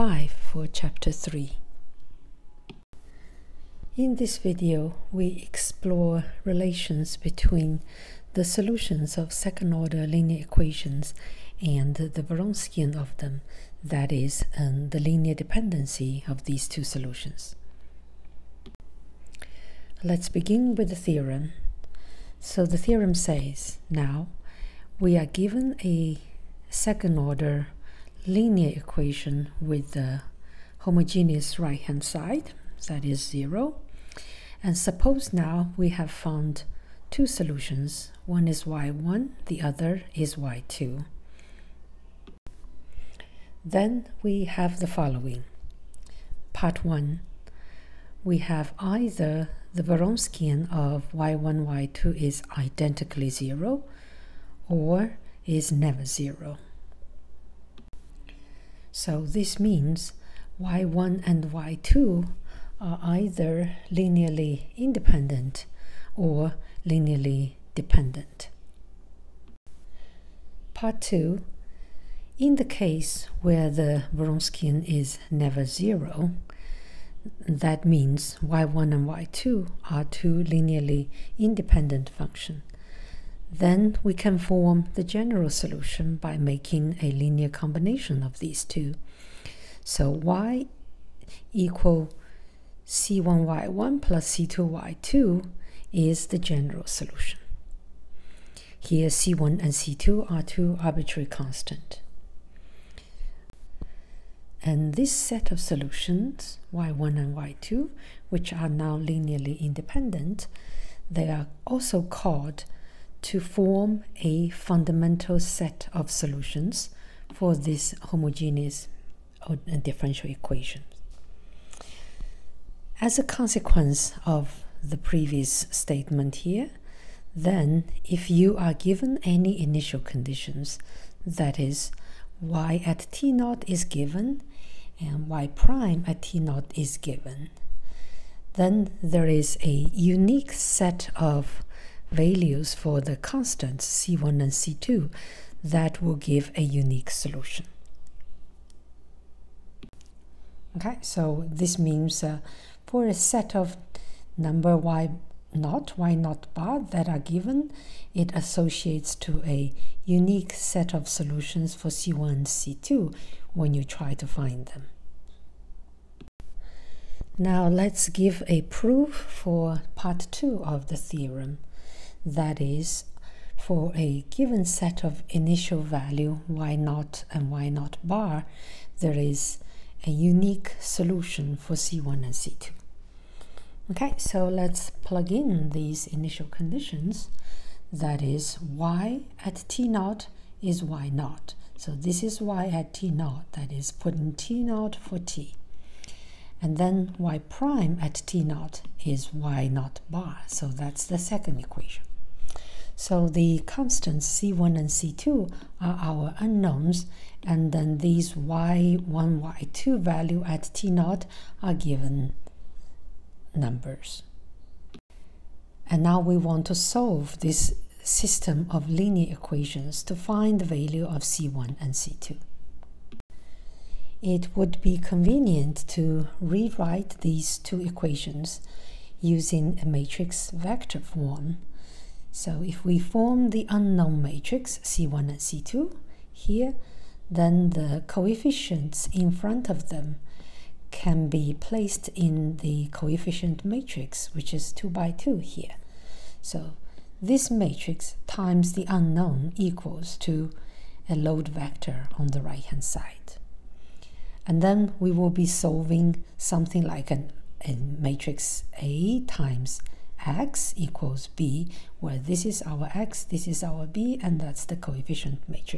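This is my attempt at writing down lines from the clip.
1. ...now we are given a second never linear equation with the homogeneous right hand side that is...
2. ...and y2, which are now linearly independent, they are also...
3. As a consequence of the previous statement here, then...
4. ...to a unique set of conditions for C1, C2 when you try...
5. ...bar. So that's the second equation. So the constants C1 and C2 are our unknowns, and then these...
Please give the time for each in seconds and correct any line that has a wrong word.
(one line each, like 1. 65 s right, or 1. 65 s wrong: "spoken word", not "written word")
1. 23 s wrong: "order", not "never"
2. 107 s right
3. 122 s right
4. 159 s wrong: "solutions", not "conditions"
5. 200 s right.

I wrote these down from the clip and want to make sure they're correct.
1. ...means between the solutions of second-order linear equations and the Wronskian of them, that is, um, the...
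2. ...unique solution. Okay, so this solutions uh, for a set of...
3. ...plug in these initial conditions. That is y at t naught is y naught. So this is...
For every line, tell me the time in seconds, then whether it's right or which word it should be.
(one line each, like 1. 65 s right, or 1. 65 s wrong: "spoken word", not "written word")
1. 6 s wrong: "relations", not "means"
2. 146 s wrong: "means", not "solutions"
3. 185 s right.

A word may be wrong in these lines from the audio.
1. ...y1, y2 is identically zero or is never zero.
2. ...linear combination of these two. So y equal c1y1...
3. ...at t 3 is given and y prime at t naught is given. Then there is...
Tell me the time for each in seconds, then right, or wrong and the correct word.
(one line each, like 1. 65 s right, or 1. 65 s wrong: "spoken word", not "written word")
1. 51 s right
2. 87 s right
3. 132 s wrong: "0", not "3".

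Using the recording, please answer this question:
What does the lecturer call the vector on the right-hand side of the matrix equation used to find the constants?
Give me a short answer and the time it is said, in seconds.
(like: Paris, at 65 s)
load vector, at 251 s.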